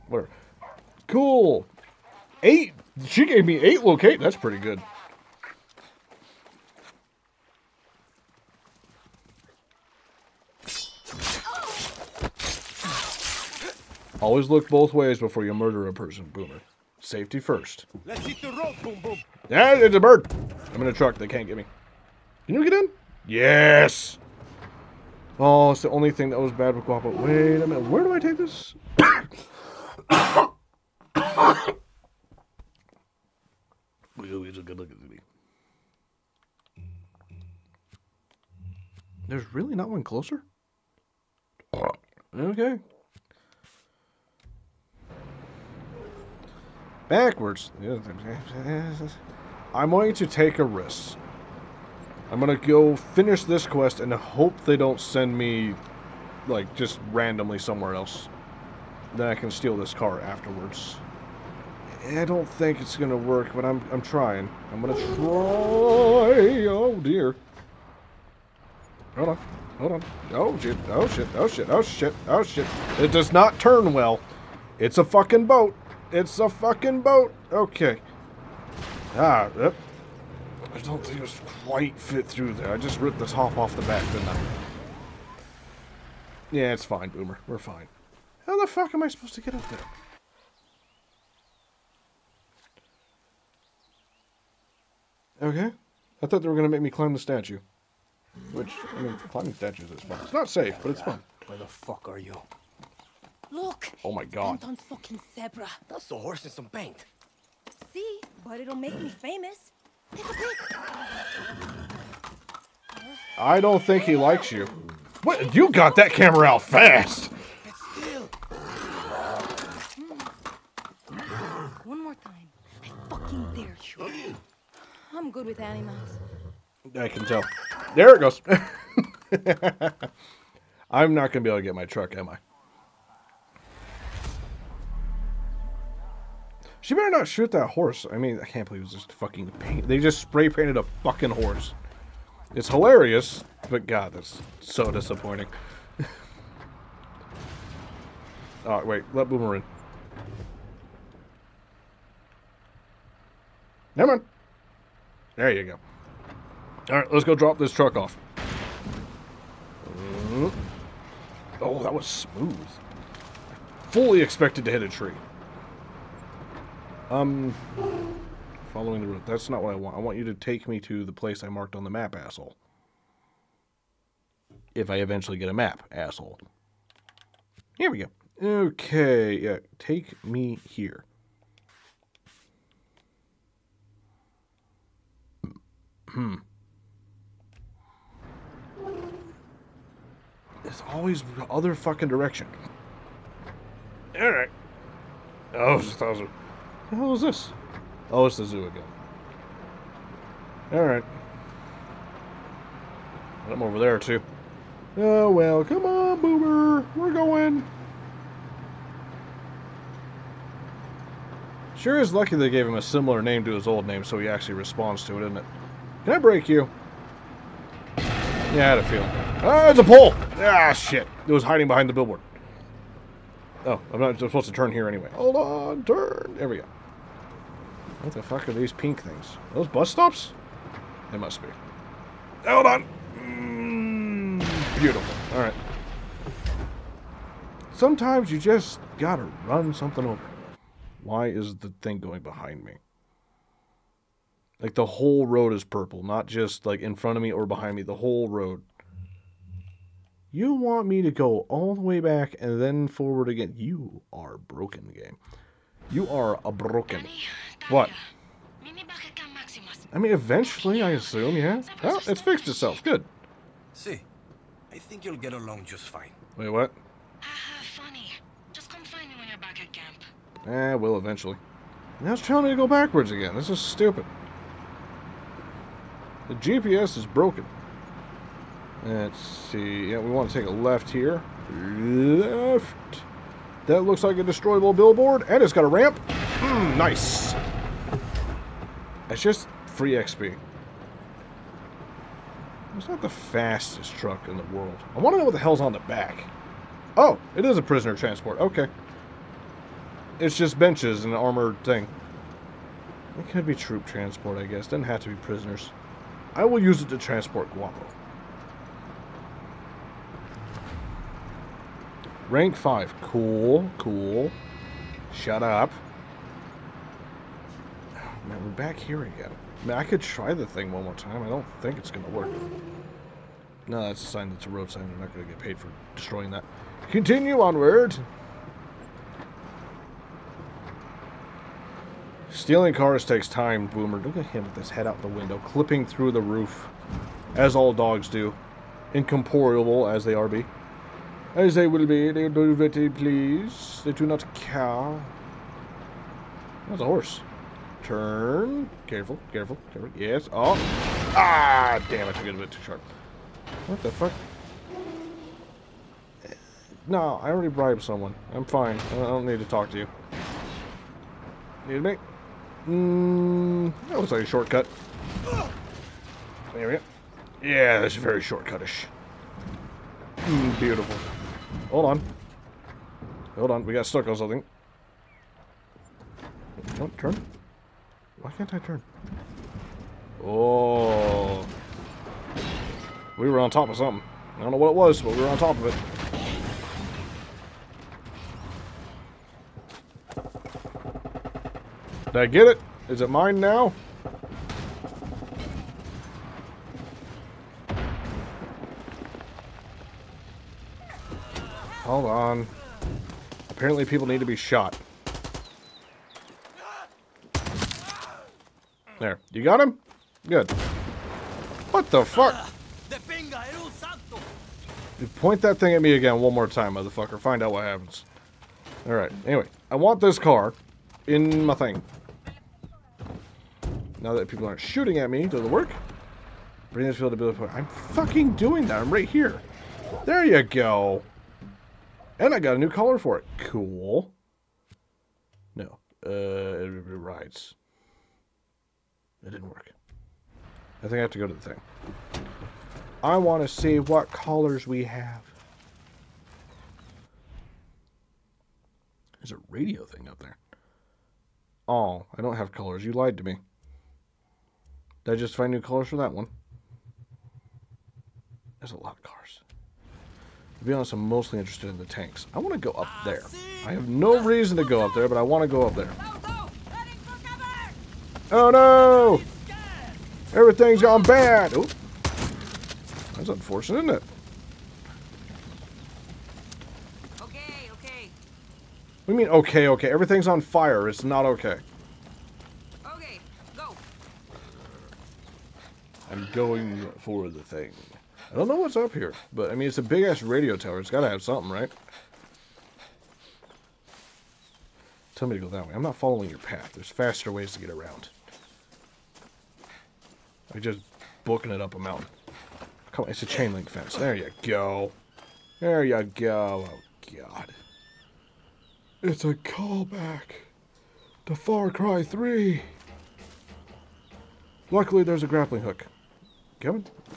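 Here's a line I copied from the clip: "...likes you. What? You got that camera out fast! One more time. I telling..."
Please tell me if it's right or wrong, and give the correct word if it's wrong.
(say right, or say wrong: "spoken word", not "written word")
wrong: "fucking", not "telling".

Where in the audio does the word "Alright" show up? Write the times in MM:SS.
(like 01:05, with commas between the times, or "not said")
02:36, 03:14, 03:20, 03:55, 06:58.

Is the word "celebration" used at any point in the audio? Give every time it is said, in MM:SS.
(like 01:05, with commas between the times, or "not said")
not said.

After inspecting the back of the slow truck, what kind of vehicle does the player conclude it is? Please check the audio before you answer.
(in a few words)
prisoner transport.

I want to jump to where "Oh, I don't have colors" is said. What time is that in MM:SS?
07:31.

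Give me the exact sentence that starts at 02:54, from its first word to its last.
If I eventually get a map, asshole.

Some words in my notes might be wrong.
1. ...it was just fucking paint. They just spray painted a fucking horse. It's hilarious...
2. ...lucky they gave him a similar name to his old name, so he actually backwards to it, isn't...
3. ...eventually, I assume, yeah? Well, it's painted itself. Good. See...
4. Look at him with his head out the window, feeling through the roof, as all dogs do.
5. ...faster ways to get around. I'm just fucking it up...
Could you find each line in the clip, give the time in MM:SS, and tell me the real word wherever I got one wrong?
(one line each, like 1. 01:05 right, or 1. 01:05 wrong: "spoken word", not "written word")
1. 02:18 right
2. 03:32 wrong: "responds", not "backwards"
3. 04:20 wrong: "fixed", not "painted"
4. 05:33 wrong: "clipping", not "feeling"
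5. 08:16 wrong: "booking", not "fucking".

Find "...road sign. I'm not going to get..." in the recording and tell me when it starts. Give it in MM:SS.
05:24.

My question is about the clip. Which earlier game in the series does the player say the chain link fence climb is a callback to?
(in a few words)
Far Cry 3.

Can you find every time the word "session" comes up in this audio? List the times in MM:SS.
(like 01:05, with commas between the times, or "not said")
not said.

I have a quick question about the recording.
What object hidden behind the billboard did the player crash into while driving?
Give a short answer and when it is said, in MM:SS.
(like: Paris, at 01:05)
a pole, at 03:39.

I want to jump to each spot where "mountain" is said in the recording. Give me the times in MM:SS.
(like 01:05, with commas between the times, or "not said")
08:21.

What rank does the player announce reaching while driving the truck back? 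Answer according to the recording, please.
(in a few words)
5.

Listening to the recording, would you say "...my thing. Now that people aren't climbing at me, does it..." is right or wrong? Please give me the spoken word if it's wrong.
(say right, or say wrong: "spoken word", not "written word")
wrong: "shooting", not "climbing".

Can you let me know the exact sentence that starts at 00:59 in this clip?
Then I can steal this car afterwards.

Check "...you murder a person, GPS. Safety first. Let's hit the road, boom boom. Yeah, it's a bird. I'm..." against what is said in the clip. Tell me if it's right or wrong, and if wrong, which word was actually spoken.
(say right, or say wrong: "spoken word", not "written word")
wrong: "Boomer", not "GPS".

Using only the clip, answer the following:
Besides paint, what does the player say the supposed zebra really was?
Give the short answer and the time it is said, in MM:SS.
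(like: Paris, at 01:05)
a horse, at 01:45.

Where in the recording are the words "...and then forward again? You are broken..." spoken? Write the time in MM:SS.
04:12.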